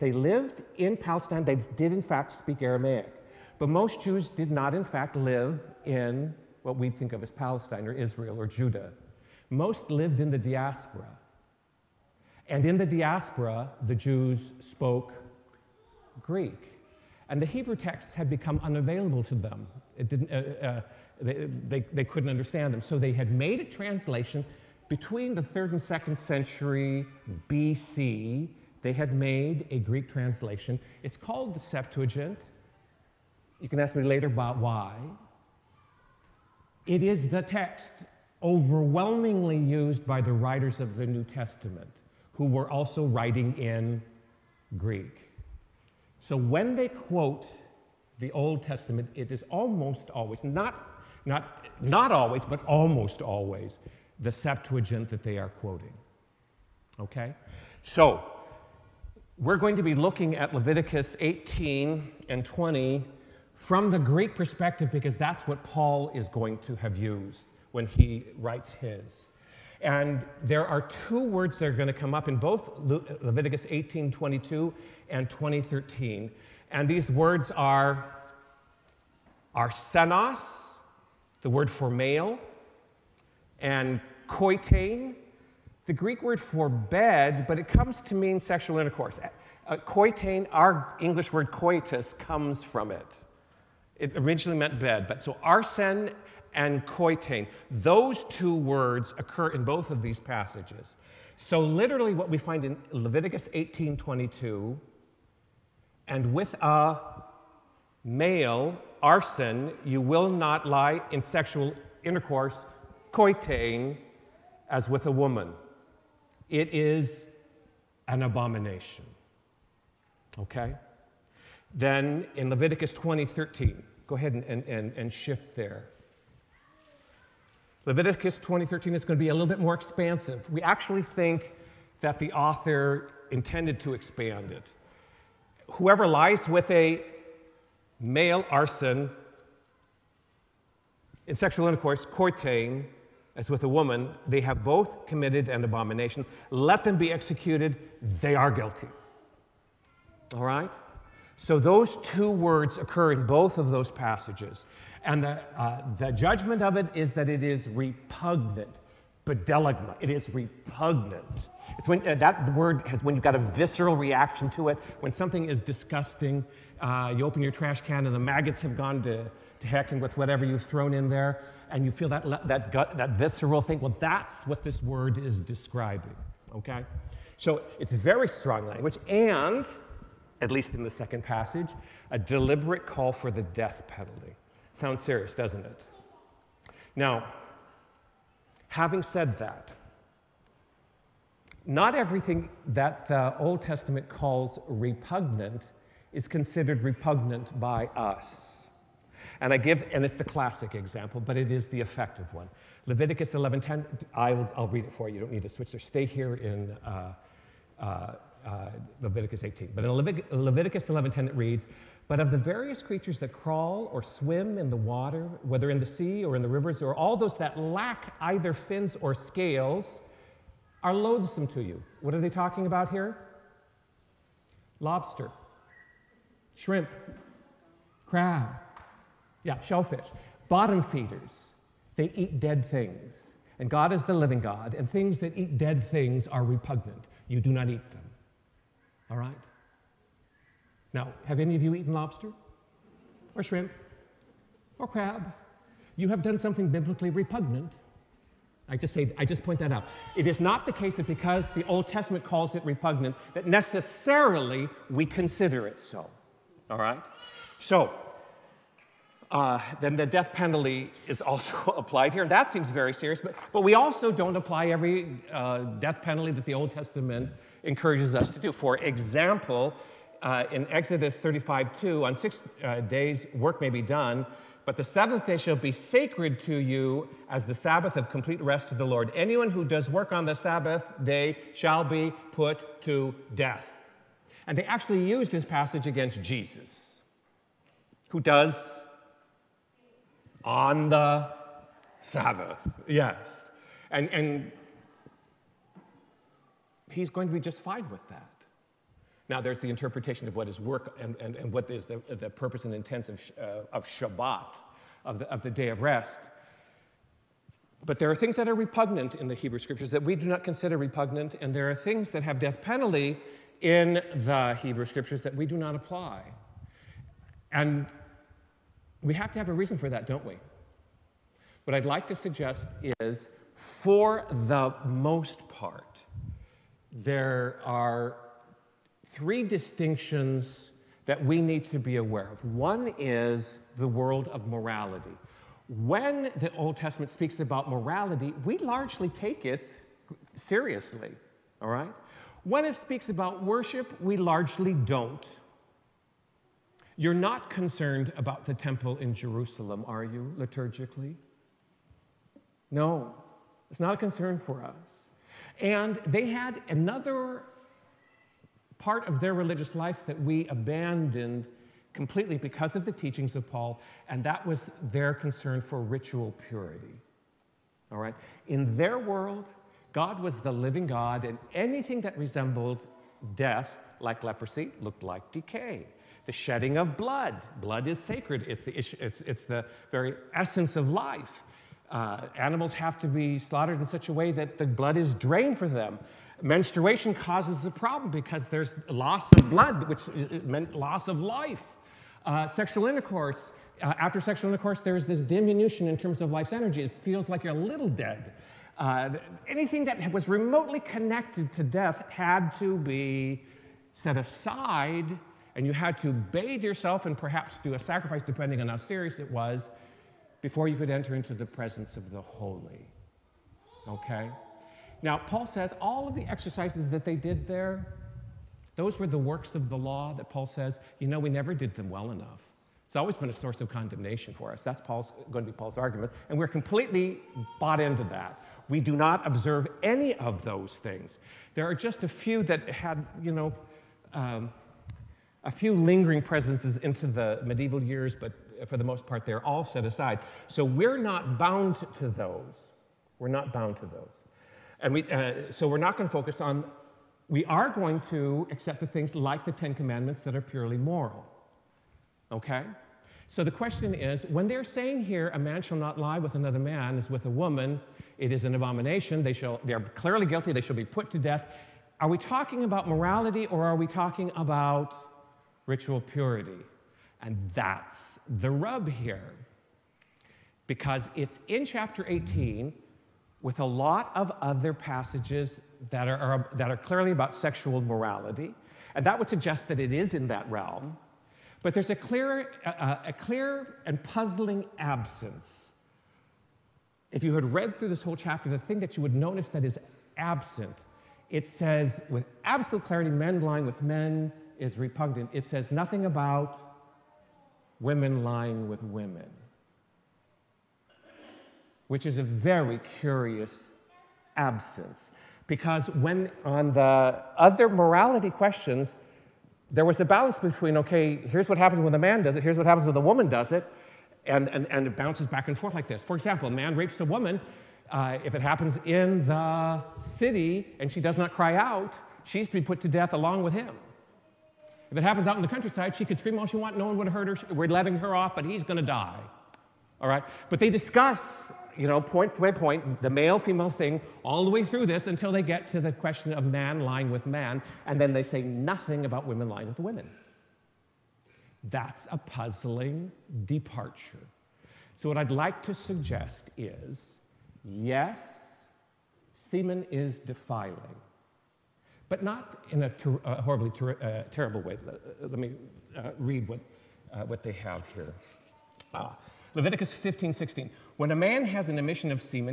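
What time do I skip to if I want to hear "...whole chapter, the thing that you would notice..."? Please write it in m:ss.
8:08.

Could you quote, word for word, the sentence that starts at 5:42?
When it speaks about worship, we largely don't.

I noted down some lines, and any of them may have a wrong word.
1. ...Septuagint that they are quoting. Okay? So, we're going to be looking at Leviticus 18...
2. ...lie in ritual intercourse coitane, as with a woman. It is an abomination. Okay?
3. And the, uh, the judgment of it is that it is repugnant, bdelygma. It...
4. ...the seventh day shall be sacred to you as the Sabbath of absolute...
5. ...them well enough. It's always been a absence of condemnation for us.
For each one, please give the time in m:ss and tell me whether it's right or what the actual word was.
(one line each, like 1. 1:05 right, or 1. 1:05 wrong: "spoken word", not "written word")
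1. 0:54 right
2. 1:50 wrong: "sexual", not "ritual"
3. 2:35 right
4. 4:34 wrong: "complete", not "absolute"
5. 7:01 wrong: "source", not "absence".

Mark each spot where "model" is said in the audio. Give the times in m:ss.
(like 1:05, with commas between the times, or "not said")
not said.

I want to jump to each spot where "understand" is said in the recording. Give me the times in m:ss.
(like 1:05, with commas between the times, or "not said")
0:22.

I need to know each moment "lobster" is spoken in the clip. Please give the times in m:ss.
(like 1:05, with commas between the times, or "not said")
3:44, 4:01.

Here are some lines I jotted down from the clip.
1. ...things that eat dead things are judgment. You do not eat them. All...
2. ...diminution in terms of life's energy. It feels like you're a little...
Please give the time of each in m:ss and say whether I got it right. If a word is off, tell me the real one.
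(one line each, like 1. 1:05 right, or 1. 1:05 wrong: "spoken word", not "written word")
1. 3:54 wrong: "repugnant", not "judgment"
2. 6:35 right.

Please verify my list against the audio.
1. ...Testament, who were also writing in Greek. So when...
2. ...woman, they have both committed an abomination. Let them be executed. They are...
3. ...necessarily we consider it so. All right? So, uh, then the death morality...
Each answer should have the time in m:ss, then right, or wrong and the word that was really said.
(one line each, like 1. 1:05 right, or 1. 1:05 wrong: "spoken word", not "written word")
1. 0:41 right
2. 2:23 right
3. 4:13 wrong: "penalty", not "morality".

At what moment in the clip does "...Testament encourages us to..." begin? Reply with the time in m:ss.
4:26.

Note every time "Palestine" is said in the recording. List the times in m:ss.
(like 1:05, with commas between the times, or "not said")
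0:00, 0:07.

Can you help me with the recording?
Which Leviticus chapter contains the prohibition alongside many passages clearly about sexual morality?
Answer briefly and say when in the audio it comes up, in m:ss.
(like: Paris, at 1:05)
chapter 18, at 7:51.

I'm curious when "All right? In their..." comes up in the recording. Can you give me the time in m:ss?
6:07.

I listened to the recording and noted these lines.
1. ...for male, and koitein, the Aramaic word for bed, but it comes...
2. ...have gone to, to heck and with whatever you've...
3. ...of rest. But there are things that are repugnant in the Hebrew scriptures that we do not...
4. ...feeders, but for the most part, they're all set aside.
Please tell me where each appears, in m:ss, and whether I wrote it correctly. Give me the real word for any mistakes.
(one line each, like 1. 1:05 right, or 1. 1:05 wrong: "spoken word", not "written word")
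1. 1:21 wrong: "Greek", not "Aramaic"
2. 2:48 right
3. 5:05 right
4. 7:17 wrong: "years", not "feeders".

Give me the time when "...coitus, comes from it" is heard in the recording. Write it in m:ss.
1:31.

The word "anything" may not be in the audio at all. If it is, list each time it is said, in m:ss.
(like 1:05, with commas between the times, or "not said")
6:11, 6:39.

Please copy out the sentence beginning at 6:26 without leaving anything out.
Menstruation causes a problem because there's loss of blood, which meant loss of life.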